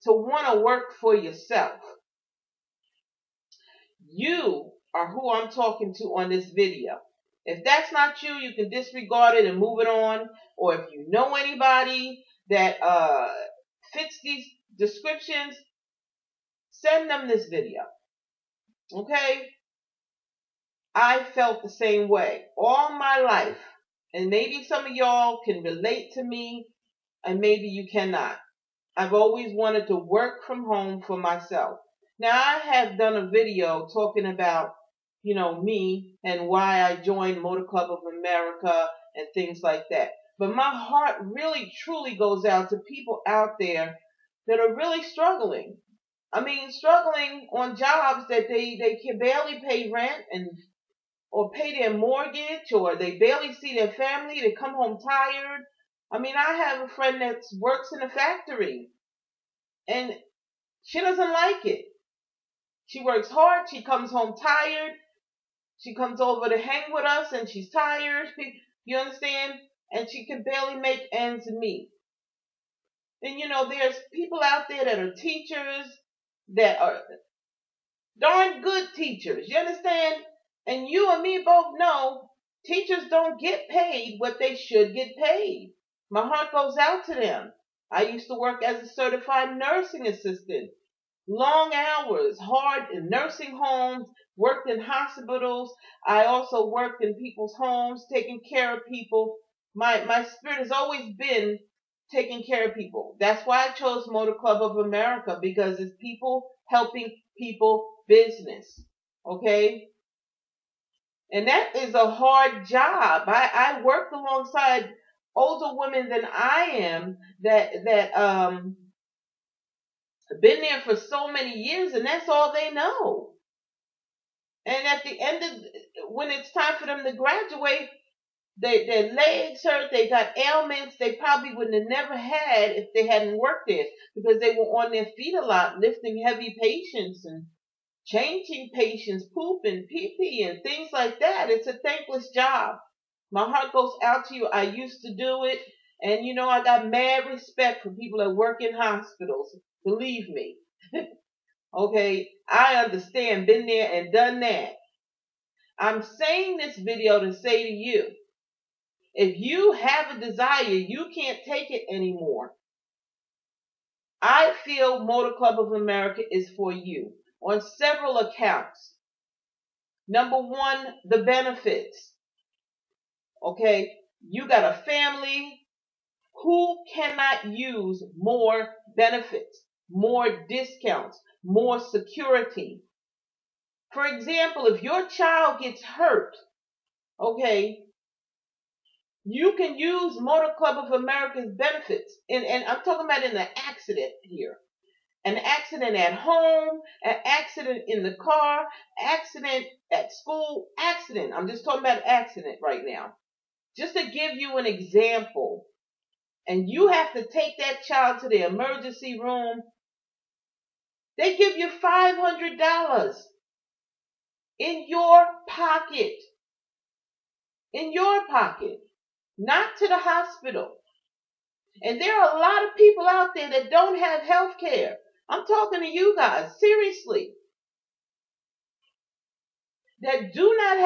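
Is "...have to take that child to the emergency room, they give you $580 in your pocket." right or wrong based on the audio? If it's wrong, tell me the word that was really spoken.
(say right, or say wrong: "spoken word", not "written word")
wrong: "500", not "580".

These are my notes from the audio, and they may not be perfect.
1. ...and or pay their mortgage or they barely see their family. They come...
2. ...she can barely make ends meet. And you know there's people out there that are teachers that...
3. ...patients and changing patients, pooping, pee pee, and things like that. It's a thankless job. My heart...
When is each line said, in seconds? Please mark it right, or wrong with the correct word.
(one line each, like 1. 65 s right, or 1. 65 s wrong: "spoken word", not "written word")
1. 50 s right
2. 70 s right
3. 136 s right.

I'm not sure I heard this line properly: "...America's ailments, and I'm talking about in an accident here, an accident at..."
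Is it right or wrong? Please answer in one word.
wrong.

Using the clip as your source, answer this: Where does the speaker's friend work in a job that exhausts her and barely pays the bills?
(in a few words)
A factory.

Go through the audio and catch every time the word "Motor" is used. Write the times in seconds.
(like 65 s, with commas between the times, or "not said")
37 s, 104 s, 165 s, 190 s.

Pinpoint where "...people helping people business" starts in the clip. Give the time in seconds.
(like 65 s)
106 s.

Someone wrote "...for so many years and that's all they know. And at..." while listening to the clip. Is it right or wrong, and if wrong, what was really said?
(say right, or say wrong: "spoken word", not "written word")
right.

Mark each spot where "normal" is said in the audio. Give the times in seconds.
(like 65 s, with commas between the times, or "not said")
not said.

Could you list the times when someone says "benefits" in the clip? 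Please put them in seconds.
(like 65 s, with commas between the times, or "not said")
171 s, 178 s, 191 s.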